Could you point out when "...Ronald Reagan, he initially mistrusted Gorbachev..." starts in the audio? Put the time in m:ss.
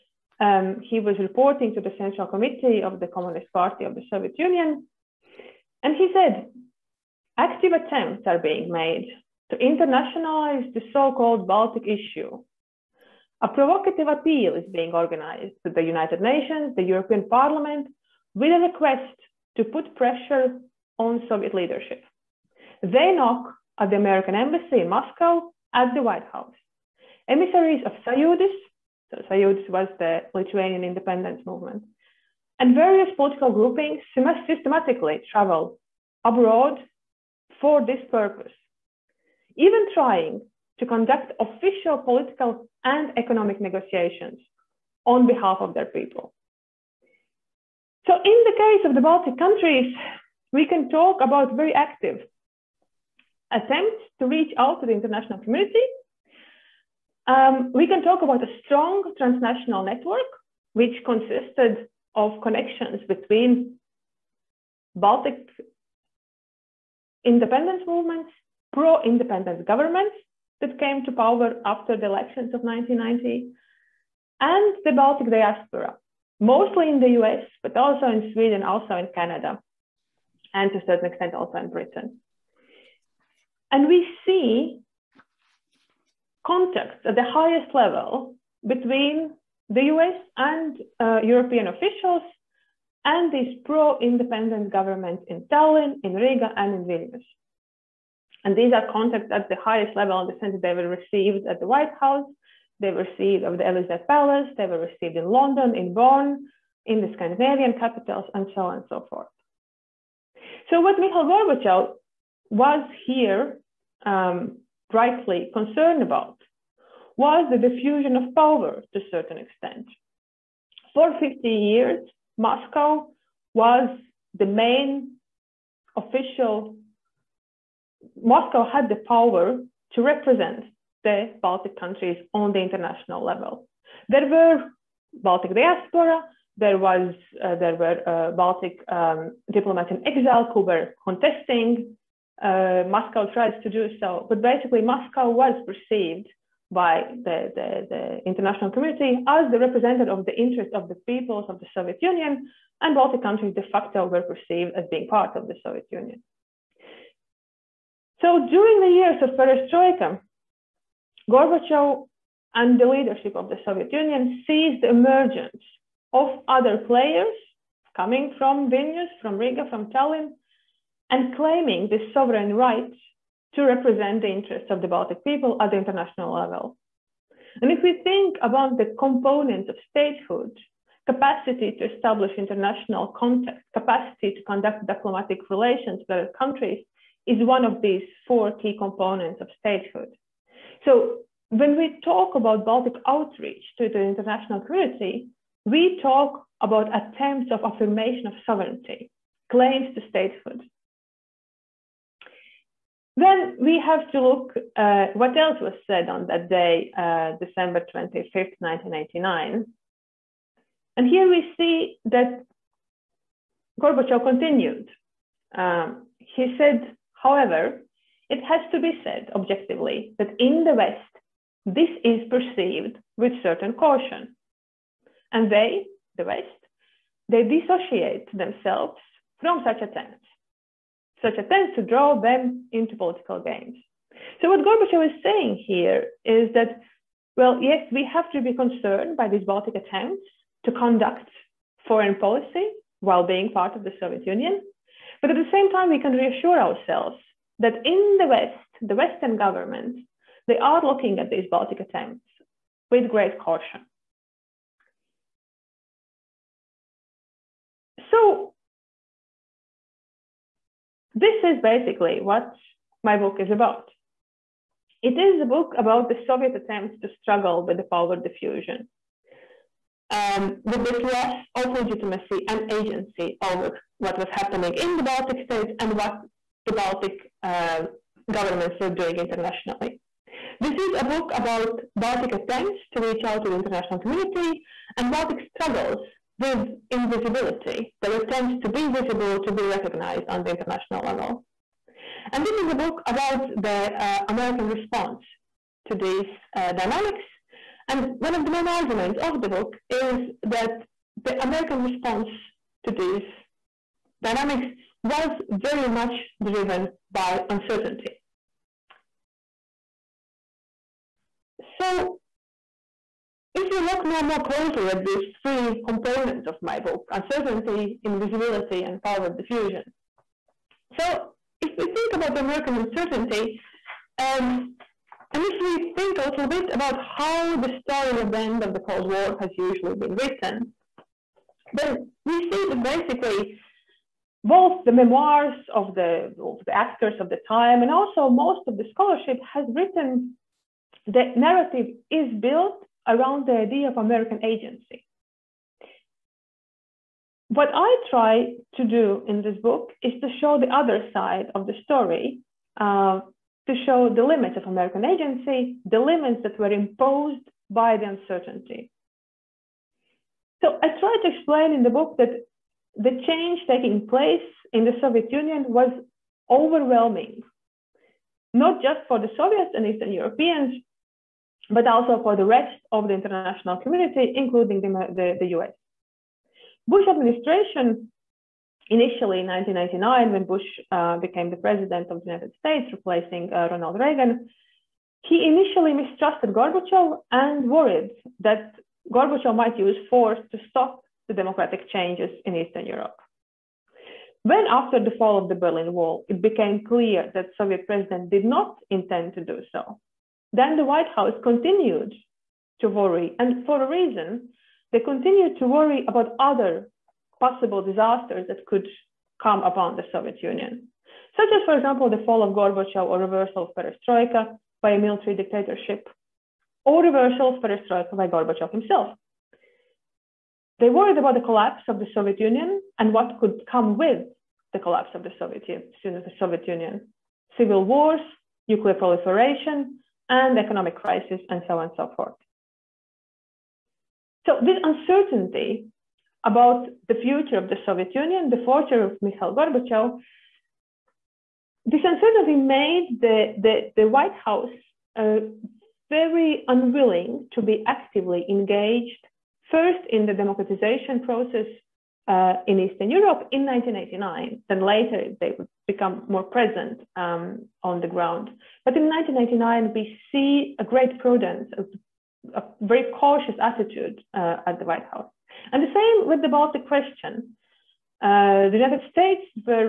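6:23.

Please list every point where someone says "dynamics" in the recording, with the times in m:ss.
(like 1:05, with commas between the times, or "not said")
4:56, 5:04.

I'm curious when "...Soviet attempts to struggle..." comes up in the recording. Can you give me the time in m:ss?
4:26.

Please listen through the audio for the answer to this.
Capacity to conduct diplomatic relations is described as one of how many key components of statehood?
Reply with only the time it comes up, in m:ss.
3:08.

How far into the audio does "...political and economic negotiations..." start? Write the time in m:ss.
0:41.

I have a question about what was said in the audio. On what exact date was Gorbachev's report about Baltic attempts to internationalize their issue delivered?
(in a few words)
December 25th, 1989.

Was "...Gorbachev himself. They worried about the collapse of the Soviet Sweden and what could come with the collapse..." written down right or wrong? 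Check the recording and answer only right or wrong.
wrong.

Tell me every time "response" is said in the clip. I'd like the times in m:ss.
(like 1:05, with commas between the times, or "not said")
4:54, 5:01.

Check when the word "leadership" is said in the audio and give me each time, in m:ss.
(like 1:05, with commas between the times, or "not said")
0:21, 2:42.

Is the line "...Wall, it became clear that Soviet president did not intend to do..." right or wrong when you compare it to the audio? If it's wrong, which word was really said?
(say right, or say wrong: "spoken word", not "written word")
right.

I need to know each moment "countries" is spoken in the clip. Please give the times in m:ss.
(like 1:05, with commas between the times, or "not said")
0:49, 2:11, 2:33, 3:06.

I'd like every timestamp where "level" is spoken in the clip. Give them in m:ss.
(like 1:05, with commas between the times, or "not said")
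1:27, 1:39, 2:13, 2:56, 4:51.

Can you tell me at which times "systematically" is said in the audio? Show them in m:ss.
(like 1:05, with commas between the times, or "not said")
0:34.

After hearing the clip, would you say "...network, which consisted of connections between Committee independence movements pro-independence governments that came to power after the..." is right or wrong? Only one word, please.
wrong.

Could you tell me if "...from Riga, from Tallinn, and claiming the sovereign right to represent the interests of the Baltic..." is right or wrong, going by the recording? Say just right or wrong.
right.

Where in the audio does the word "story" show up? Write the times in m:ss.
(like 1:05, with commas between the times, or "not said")
5:27, 5:51.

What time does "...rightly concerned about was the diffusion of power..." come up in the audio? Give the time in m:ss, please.
1:54.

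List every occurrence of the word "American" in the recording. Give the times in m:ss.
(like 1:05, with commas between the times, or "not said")
0:23, 4:54, 5:01, 5:22, 5:43, 5:54.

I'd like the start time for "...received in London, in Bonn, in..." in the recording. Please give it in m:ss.
1:44.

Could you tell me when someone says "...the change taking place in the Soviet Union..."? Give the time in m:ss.
6:02.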